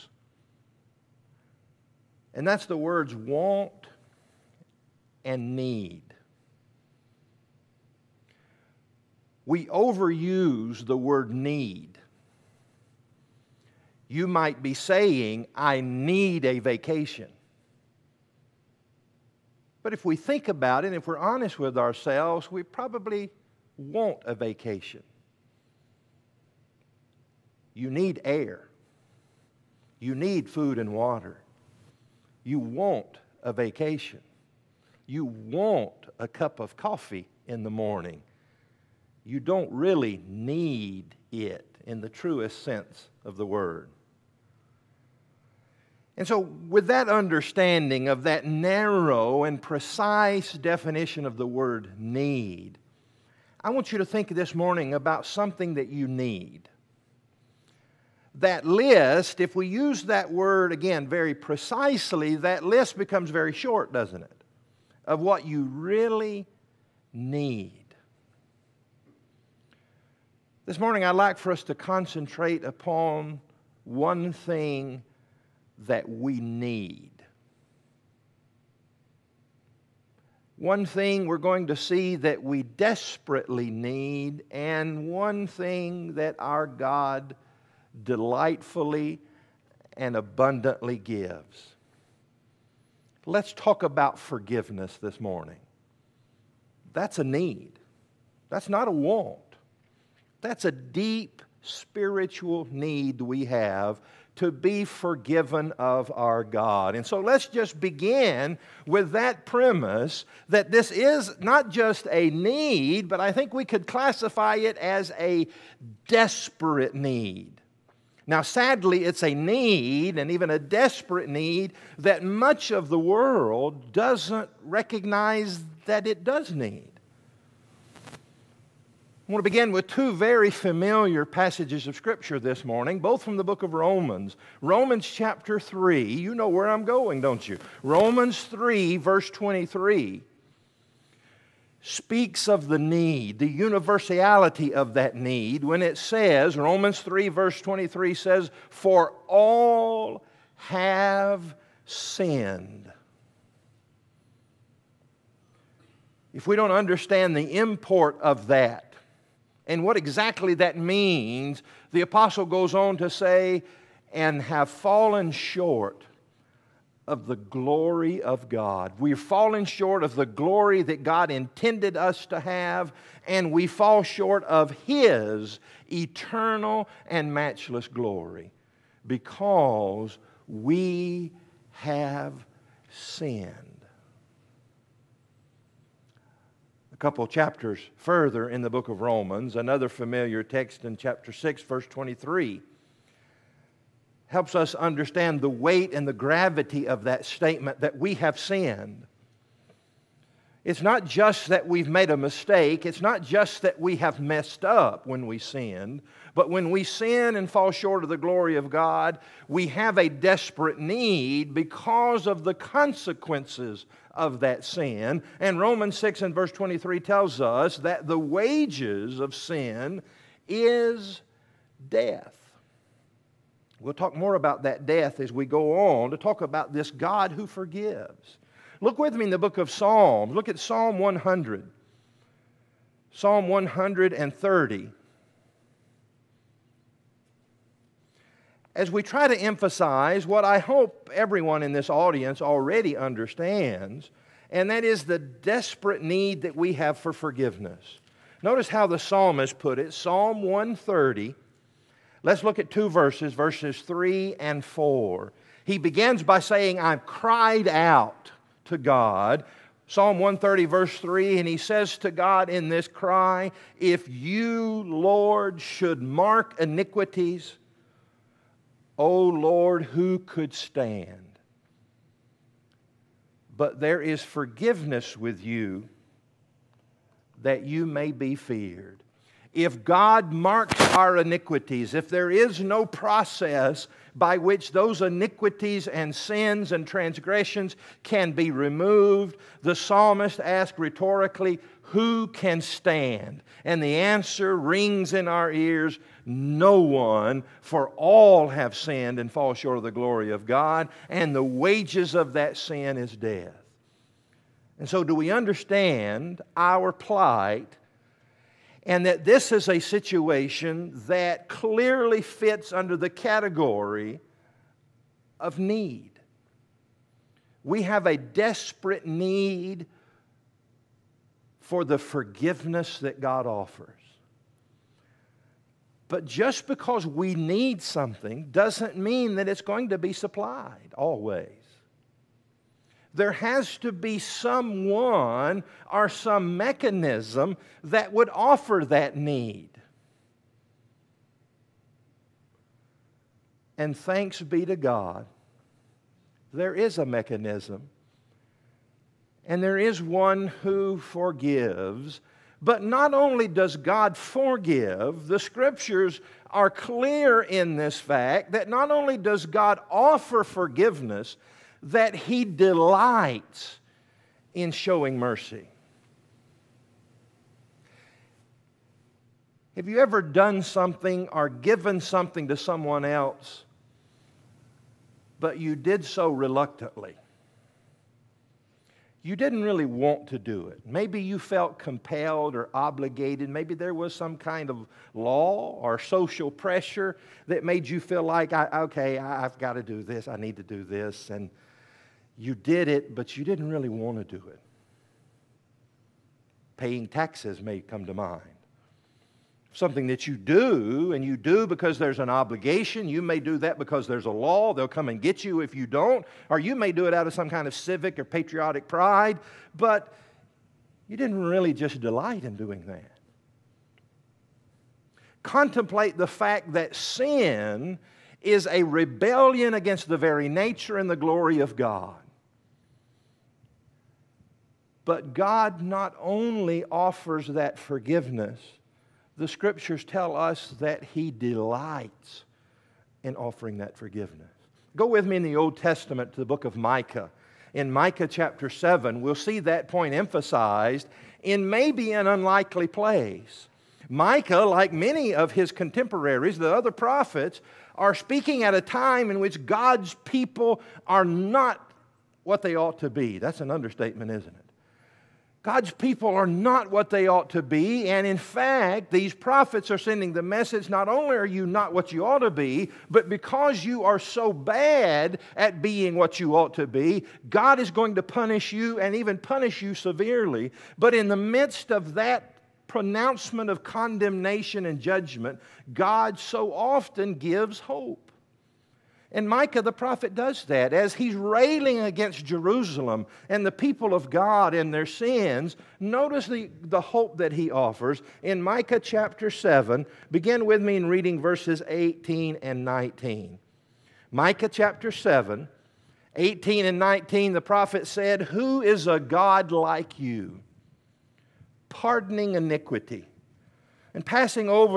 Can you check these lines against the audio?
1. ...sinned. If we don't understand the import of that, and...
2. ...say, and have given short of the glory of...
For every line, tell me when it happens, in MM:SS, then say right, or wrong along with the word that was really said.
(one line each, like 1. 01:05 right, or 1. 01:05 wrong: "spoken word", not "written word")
1. 02:31 right
2. 02:43 wrong: "fallen", not "given".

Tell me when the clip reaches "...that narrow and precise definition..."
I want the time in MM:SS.
00:48.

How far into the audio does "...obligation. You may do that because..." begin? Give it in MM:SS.
06:42.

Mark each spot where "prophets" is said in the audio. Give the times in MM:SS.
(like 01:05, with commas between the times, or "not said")
07:26, 07:39, 07:59, 08:17.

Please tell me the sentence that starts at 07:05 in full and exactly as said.
But God not only offers that forgiveness, the scriptures tell us that He delights in offering that forgiveness.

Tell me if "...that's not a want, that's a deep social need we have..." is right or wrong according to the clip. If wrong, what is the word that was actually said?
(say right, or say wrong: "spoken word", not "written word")
wrong: "spiritual", not "social".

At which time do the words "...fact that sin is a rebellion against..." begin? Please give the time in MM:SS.
06:56.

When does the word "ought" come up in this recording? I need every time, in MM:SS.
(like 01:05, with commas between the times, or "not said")
07:32, 07:37, 07:42, 07:46.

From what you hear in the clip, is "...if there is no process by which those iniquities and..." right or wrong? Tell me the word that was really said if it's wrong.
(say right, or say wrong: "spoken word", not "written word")
right.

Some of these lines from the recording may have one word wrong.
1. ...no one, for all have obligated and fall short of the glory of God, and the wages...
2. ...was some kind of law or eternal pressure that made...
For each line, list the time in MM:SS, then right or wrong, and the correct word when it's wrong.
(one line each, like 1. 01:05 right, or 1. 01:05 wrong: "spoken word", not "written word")
1. 04:56 wrong: "sinned", not "obligated"
2. 06:23 wrong: "social", not "eternal".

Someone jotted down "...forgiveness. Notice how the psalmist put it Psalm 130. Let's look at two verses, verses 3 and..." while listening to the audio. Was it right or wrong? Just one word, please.
right.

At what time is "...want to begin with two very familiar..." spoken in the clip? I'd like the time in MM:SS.
02:09.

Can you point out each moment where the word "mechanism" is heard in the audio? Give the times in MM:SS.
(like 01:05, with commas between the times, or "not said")
05:36, 05:47.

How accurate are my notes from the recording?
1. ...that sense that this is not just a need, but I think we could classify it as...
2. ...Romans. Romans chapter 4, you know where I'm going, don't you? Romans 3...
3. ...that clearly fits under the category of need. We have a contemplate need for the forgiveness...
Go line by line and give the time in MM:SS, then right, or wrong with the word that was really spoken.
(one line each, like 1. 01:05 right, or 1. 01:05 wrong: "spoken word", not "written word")
1. 01:49 wrong: "premise", not "sense"
2. 02:13 wrong: "3", not "4"
3. 05:11 wrong: "desperate", not "contemplate".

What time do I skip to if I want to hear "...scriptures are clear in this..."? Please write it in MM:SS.
05:55.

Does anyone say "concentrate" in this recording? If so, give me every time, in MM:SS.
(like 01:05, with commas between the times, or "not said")
01:11.